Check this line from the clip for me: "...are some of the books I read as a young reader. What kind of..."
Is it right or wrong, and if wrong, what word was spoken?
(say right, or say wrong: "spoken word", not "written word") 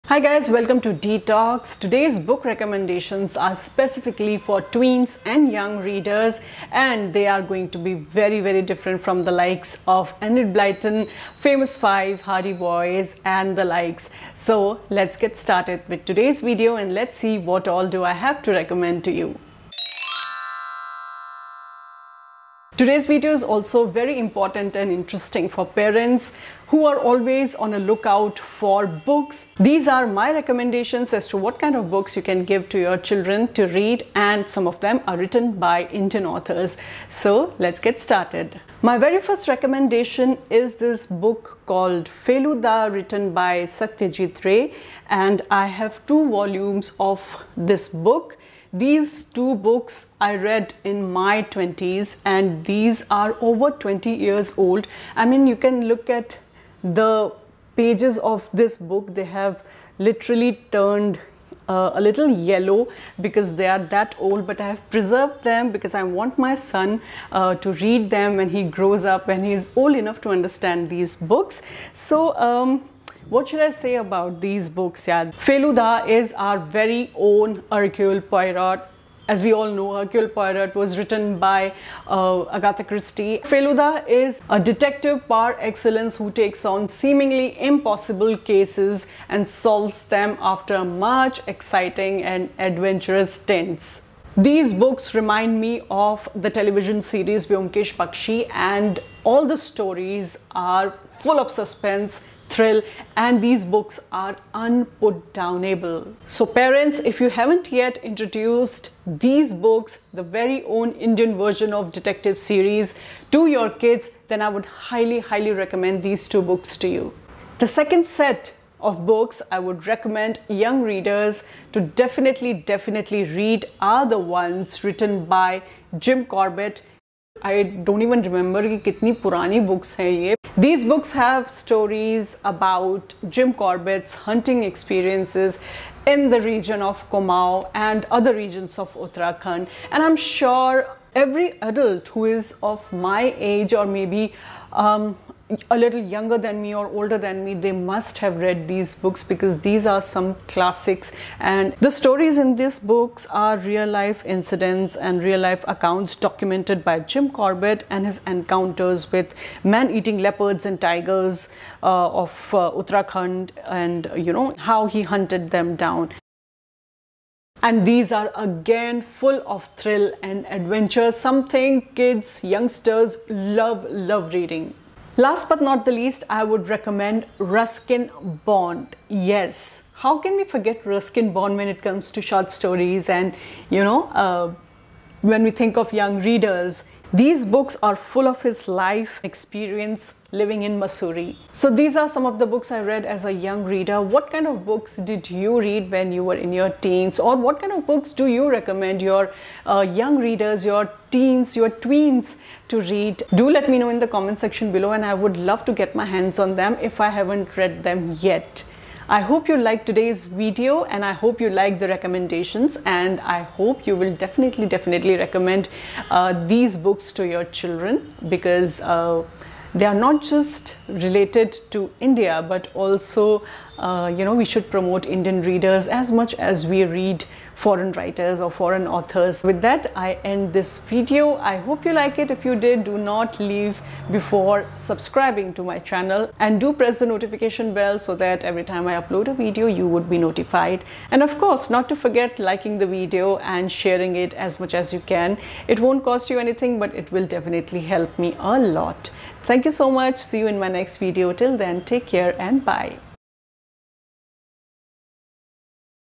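right.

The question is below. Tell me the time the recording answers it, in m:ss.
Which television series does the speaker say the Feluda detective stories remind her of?
1:37.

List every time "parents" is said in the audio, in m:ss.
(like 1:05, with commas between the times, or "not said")
0:25, 1:46.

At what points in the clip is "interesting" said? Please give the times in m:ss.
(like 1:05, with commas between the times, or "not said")
0:24.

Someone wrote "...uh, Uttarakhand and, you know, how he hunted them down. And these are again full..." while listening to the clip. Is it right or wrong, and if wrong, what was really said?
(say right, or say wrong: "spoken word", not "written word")
right.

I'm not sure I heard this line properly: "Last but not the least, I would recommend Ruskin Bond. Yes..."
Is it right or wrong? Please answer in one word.
right.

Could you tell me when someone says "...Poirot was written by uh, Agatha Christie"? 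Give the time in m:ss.
1:20.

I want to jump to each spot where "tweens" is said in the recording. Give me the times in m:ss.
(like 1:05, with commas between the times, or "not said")
0:04, 3:21.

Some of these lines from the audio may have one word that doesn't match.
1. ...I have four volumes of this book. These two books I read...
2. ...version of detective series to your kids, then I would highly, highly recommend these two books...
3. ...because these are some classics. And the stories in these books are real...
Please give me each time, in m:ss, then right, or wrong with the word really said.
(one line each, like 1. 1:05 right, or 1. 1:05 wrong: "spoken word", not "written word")
1. 0:45 wrong: "two", not "four"
2. 1:51 right
3. 2:29 right.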